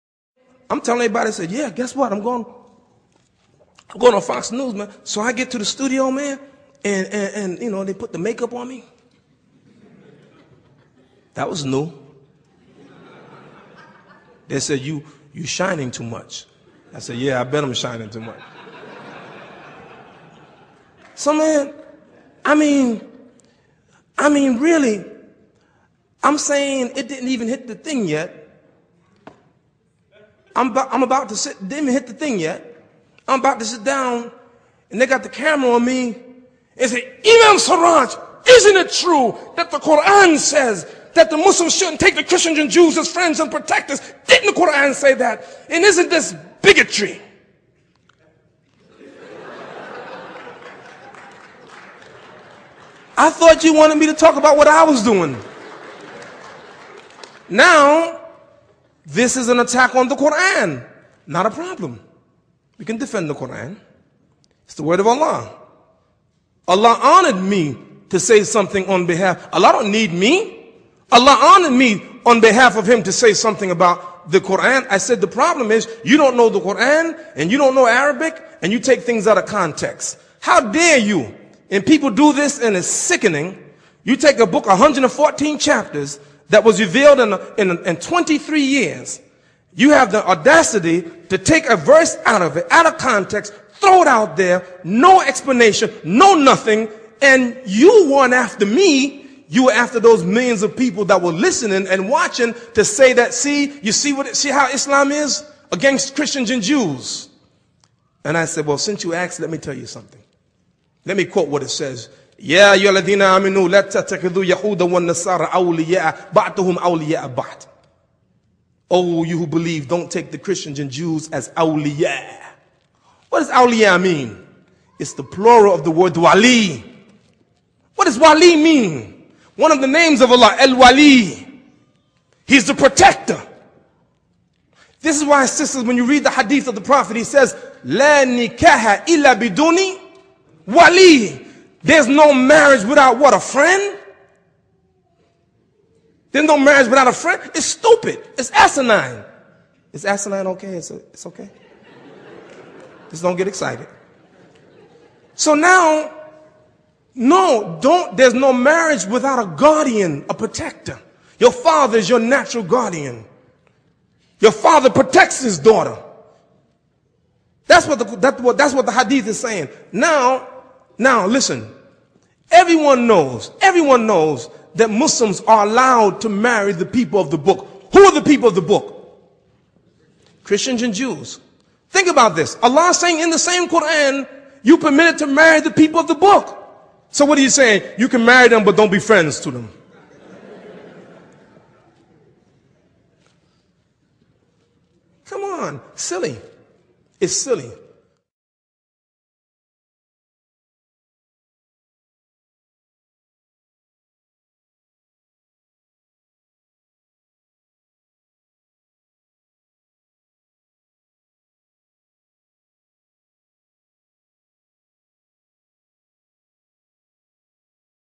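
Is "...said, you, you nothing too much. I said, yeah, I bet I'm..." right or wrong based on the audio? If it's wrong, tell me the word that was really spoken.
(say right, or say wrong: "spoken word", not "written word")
wrong: "shining", not "nothing".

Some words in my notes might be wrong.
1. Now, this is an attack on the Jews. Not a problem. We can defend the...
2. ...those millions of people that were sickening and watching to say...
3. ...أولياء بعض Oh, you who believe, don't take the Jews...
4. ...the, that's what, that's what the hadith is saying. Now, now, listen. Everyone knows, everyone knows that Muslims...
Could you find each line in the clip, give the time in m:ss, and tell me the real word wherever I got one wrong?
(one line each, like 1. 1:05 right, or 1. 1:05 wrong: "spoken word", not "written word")
1. 0:57 wrong: "Quran", not "Jews"
2. 1:39 wrong: "listening", not "sickening"
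3. 1:56 wrong: "Christians", not "Jews"
4. 2:47 right.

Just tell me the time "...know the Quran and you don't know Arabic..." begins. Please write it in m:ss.
1:16.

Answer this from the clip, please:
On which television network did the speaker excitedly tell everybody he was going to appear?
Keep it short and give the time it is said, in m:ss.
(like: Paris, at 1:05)
Fox News, at 0:04.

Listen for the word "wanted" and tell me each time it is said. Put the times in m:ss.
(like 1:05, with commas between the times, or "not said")
0:53.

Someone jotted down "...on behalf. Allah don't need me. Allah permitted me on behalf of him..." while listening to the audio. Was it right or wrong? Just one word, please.
wrong.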